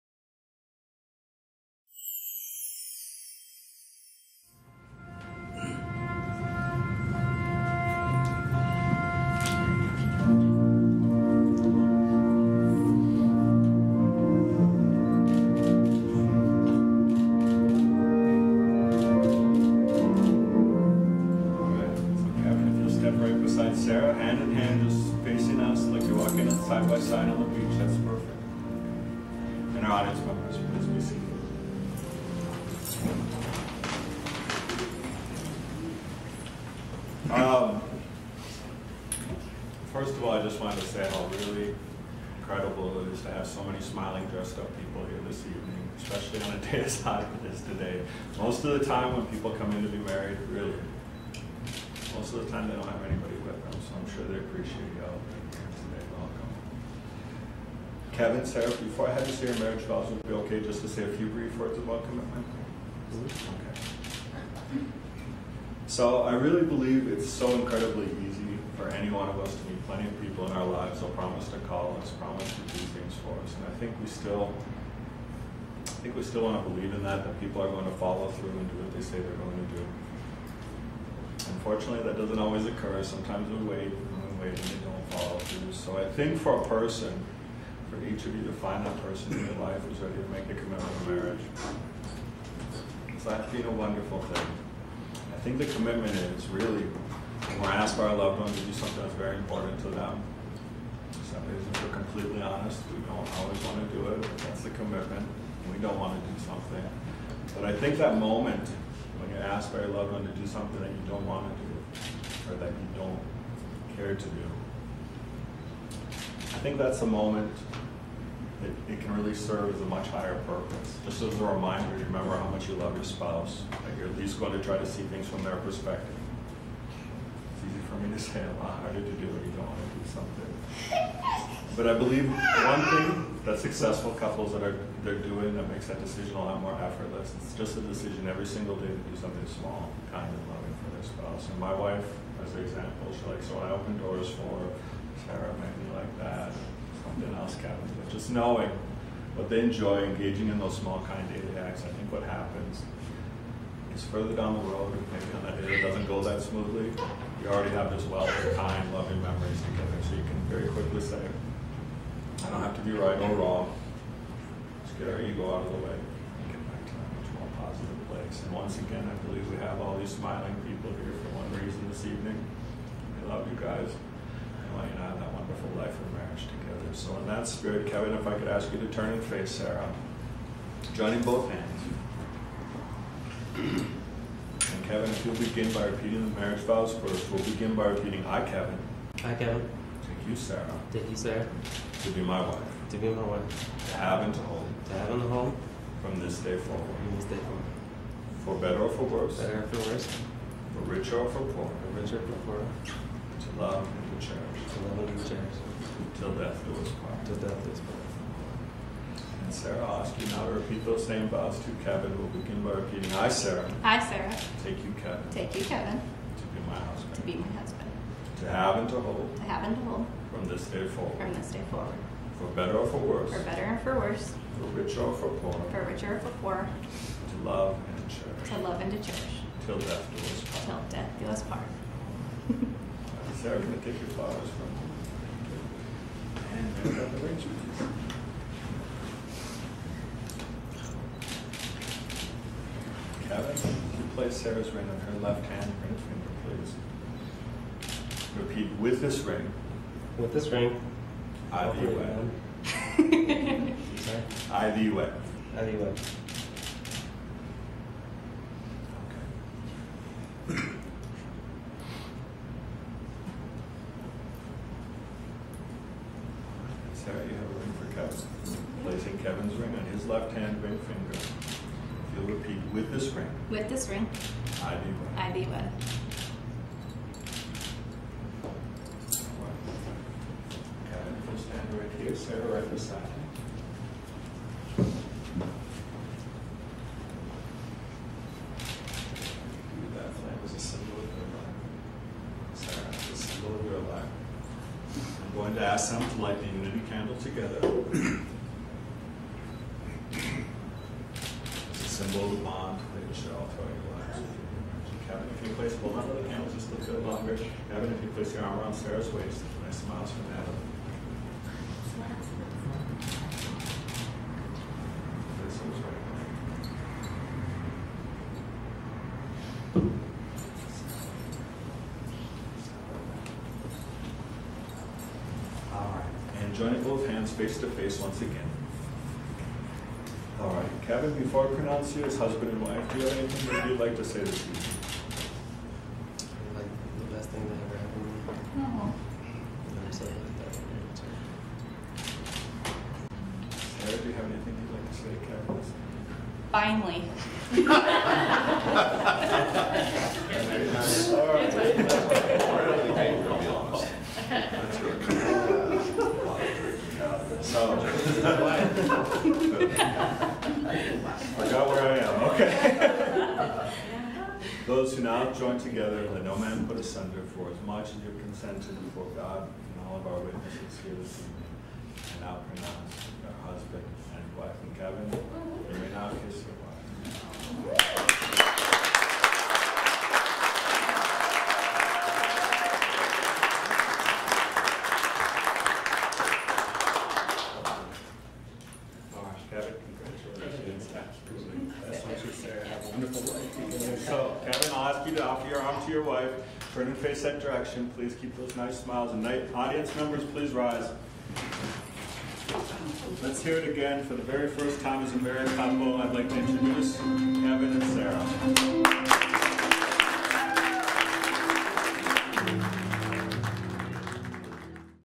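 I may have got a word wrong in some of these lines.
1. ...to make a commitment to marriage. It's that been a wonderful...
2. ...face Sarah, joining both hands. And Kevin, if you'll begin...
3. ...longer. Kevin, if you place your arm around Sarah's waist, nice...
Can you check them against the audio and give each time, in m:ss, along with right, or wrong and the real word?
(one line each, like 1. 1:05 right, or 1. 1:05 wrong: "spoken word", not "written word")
1. 1:30 right
2. 2:59 right
3. 5:07 right.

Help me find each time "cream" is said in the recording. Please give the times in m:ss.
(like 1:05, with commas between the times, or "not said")
not said.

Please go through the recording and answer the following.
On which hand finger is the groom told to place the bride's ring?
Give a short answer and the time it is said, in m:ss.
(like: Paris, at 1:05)
left hand ring finger, at 4:05.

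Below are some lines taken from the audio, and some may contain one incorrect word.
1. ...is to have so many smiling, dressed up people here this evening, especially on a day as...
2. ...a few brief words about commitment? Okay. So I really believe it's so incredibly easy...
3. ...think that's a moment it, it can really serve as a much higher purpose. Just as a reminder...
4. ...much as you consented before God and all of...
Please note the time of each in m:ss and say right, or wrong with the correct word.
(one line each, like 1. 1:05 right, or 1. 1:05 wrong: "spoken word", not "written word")
1. 0:43 right
2. 1:01 right
3. 1:56 right
4. 6:07 right.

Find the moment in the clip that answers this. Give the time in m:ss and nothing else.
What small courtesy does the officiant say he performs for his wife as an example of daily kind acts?
2:23.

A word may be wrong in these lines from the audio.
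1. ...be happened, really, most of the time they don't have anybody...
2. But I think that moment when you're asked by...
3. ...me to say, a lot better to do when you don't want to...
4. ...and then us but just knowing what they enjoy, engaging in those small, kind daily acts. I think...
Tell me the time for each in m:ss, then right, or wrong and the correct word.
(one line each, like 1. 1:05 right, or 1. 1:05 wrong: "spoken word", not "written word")
1. 0:49 wrong: "married", not "happened"
2. 1:47 right
3. 2:07 wrong: "harder", not "better"
4. 2:27 right.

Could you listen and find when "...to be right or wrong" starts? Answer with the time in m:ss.
2:42.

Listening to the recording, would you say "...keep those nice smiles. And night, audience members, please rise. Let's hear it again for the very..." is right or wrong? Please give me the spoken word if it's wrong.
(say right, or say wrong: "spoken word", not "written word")
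right.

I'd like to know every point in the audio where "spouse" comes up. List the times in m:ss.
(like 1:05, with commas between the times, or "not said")
2:03, 2:21.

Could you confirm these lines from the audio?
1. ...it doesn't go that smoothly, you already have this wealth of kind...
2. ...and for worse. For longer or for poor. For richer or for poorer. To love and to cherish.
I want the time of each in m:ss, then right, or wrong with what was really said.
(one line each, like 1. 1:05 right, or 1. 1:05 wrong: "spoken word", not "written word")
1. 2:35 right
2. 3:43 wrong: "richer", not "longer".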